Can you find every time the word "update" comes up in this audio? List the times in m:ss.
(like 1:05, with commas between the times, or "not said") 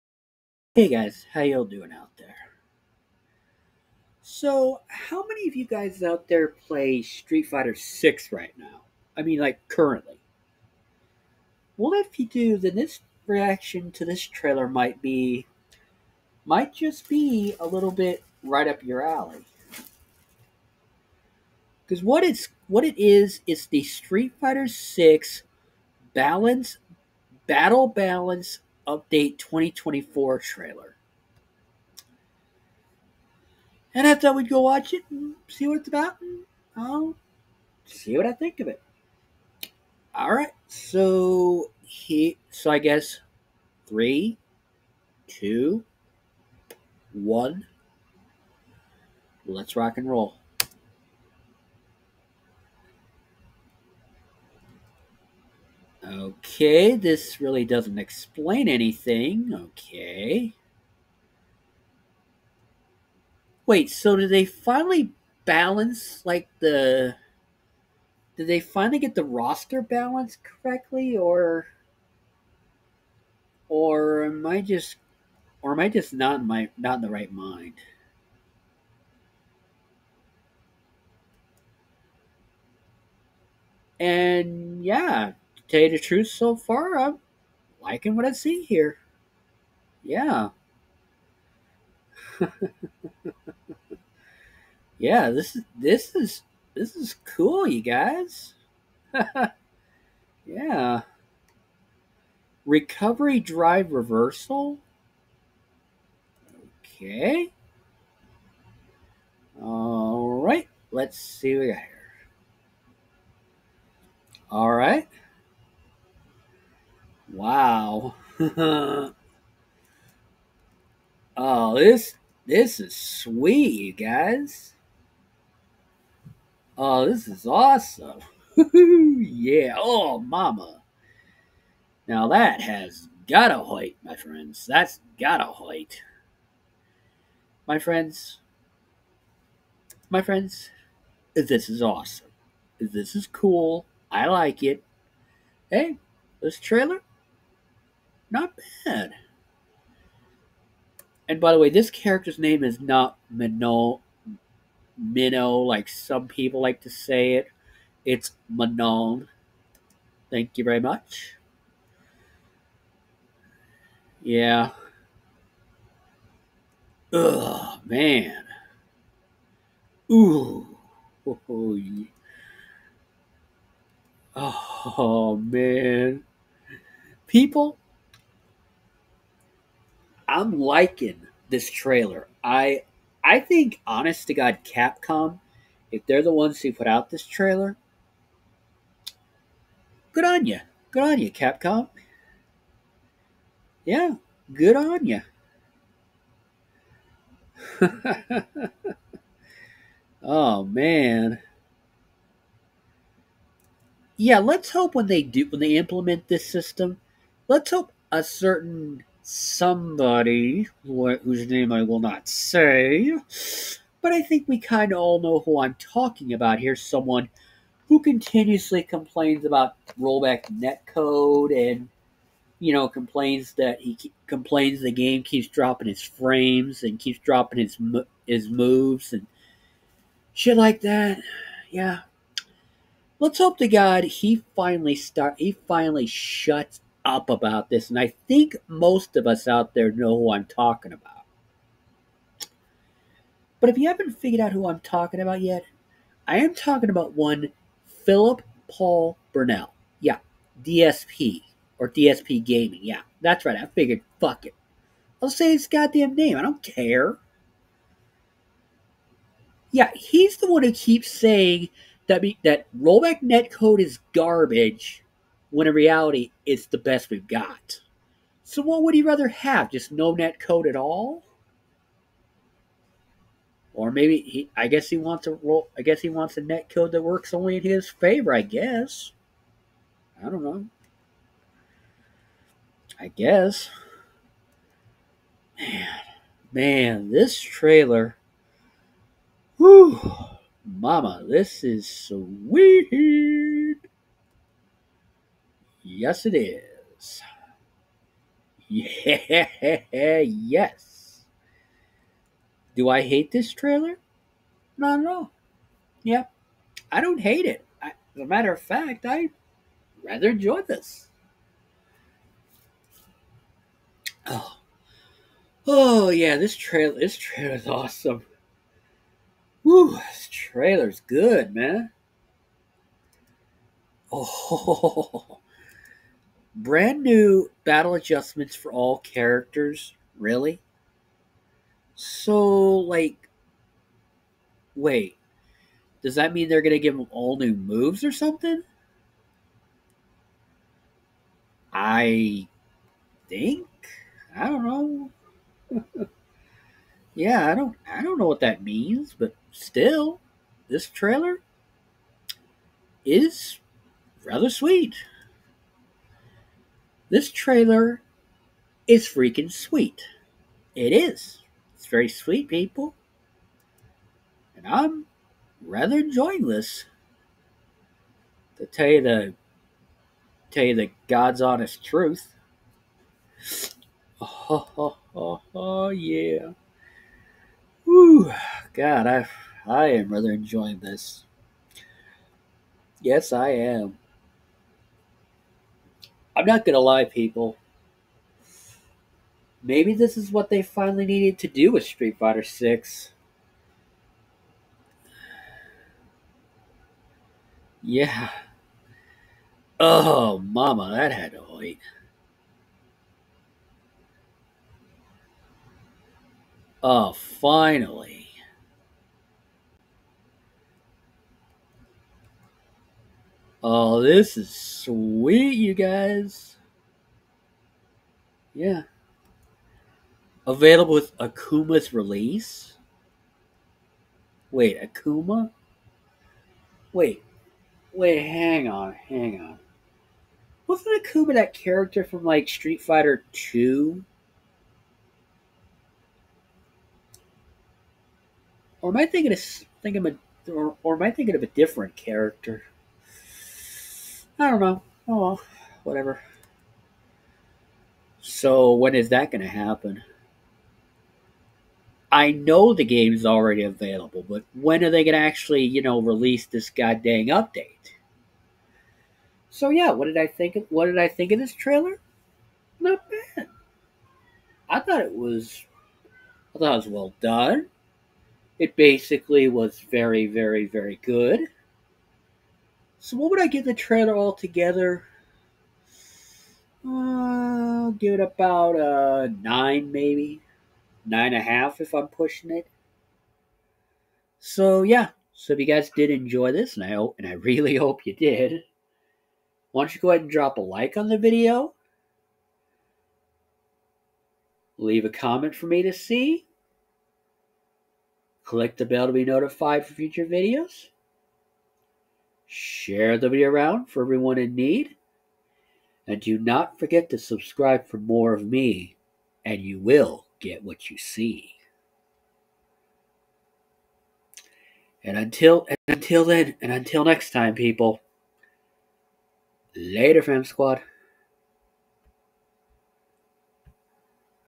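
0:28, 7:37.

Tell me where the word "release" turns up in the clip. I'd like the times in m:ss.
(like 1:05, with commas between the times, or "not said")
7:01, 7:36.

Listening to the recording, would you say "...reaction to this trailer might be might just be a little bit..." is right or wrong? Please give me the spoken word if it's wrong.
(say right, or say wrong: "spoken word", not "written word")
right.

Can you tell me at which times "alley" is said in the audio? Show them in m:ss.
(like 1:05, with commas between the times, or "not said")
0:19.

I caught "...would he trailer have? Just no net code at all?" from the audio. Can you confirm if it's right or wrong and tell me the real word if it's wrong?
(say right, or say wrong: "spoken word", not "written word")
wrong: "rather", not "trailer".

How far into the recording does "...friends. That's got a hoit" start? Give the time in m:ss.
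2:14.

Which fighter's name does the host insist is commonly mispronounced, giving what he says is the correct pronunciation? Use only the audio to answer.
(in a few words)
Manon.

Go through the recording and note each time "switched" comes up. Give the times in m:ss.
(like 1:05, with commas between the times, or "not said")
not said.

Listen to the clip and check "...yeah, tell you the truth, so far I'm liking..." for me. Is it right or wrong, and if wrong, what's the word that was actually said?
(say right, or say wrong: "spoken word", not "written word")
right.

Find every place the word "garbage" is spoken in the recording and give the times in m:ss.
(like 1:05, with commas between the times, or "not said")
4:24.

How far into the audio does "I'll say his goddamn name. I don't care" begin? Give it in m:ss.
4:15.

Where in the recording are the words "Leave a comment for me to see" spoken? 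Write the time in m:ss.
8:14.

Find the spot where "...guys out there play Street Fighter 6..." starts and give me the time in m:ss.
0:05.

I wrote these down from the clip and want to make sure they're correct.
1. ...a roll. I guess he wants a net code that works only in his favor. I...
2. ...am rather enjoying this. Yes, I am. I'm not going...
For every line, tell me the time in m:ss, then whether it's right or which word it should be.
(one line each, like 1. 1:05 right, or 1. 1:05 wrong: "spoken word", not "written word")
1. 4:35 right
2. 6:19 right.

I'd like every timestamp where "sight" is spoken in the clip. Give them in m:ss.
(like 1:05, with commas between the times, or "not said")
not said.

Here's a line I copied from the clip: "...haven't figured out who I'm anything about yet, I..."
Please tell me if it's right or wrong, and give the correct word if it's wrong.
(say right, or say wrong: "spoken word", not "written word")
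wrong: "talking", not "anything".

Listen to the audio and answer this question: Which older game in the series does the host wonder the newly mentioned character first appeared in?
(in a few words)
Street Fighter 2.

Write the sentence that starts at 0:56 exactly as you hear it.
Okay, this really doesn't explain anything.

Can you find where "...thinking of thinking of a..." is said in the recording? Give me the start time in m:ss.
7:19.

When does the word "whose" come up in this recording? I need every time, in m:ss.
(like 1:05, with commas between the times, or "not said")
3:31.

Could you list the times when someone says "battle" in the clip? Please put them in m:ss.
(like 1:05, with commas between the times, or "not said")
0:27, 5:27.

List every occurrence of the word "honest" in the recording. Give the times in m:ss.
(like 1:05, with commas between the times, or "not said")
3:03, 6:11.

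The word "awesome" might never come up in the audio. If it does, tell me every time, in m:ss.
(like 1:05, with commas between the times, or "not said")
2:07, 2:21, 5:17.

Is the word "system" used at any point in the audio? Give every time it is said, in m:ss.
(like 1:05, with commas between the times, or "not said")
3:26.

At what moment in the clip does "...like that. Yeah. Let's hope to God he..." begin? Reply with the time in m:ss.
3:50.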